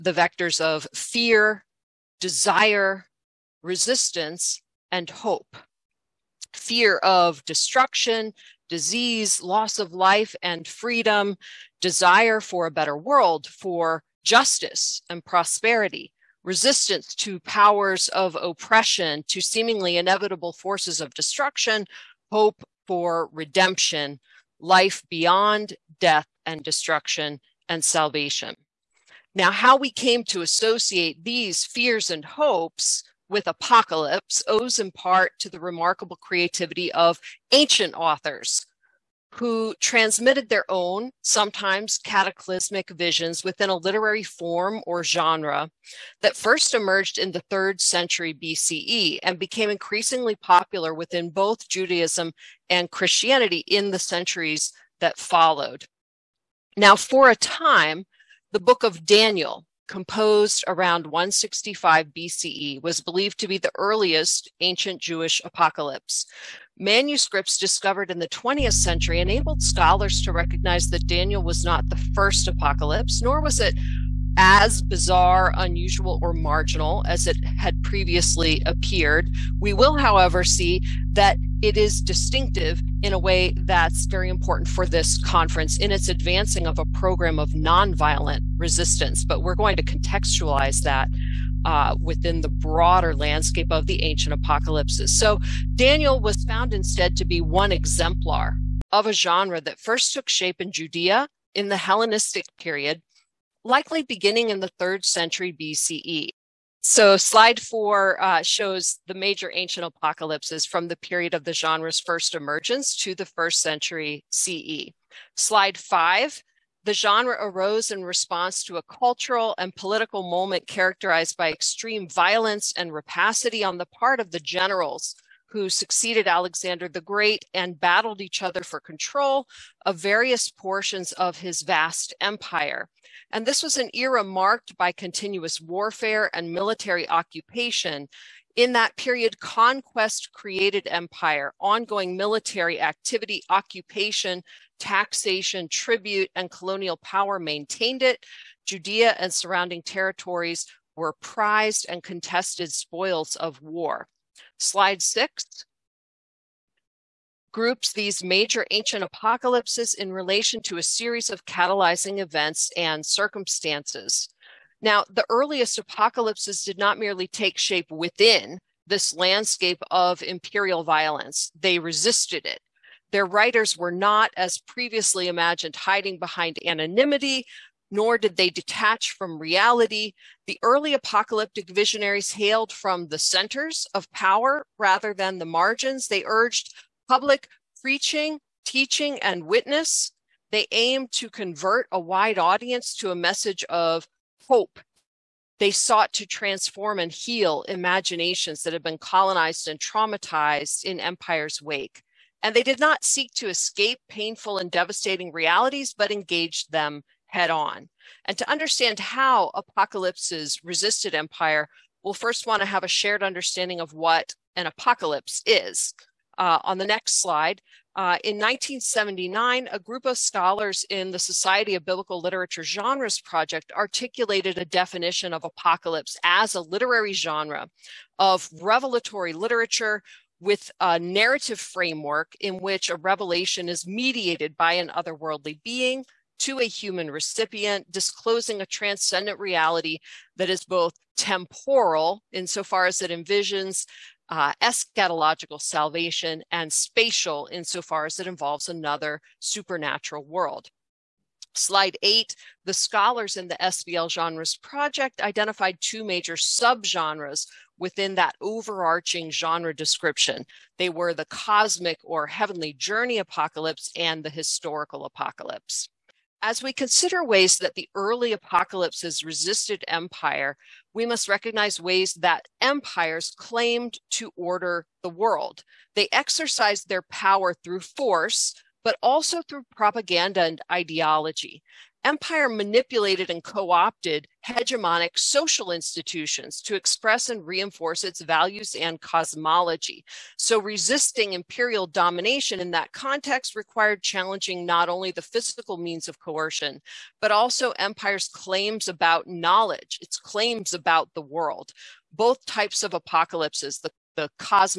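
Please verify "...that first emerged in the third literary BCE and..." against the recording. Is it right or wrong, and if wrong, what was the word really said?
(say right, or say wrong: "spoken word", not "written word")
wrong: "century", not "literary".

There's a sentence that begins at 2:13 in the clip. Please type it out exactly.
And this was an era marked by continuous warfare and military occupation.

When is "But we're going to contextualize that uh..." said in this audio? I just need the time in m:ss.
1:29.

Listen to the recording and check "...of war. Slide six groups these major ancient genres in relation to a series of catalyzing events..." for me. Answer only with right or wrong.
wrong.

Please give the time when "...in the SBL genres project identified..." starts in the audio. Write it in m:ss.
4:13.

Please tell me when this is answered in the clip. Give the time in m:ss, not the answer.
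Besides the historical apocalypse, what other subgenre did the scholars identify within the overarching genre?
4:21.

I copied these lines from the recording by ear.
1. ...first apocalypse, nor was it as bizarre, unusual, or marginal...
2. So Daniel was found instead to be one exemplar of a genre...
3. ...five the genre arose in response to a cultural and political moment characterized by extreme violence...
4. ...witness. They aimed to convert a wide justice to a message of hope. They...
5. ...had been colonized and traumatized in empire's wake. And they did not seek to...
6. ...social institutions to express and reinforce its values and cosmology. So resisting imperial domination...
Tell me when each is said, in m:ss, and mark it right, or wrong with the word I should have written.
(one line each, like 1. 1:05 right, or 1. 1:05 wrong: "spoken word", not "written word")
1. 1:11 right
2. 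1:35 right
3. 1:55 right
4. 3:09 wrong: "audience", not "justice"
5. 3:18 right
6. 4:45 right.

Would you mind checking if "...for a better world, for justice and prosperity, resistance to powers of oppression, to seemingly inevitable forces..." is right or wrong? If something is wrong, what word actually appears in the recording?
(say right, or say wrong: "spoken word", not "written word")
right.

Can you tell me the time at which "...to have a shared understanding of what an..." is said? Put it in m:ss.
3:32.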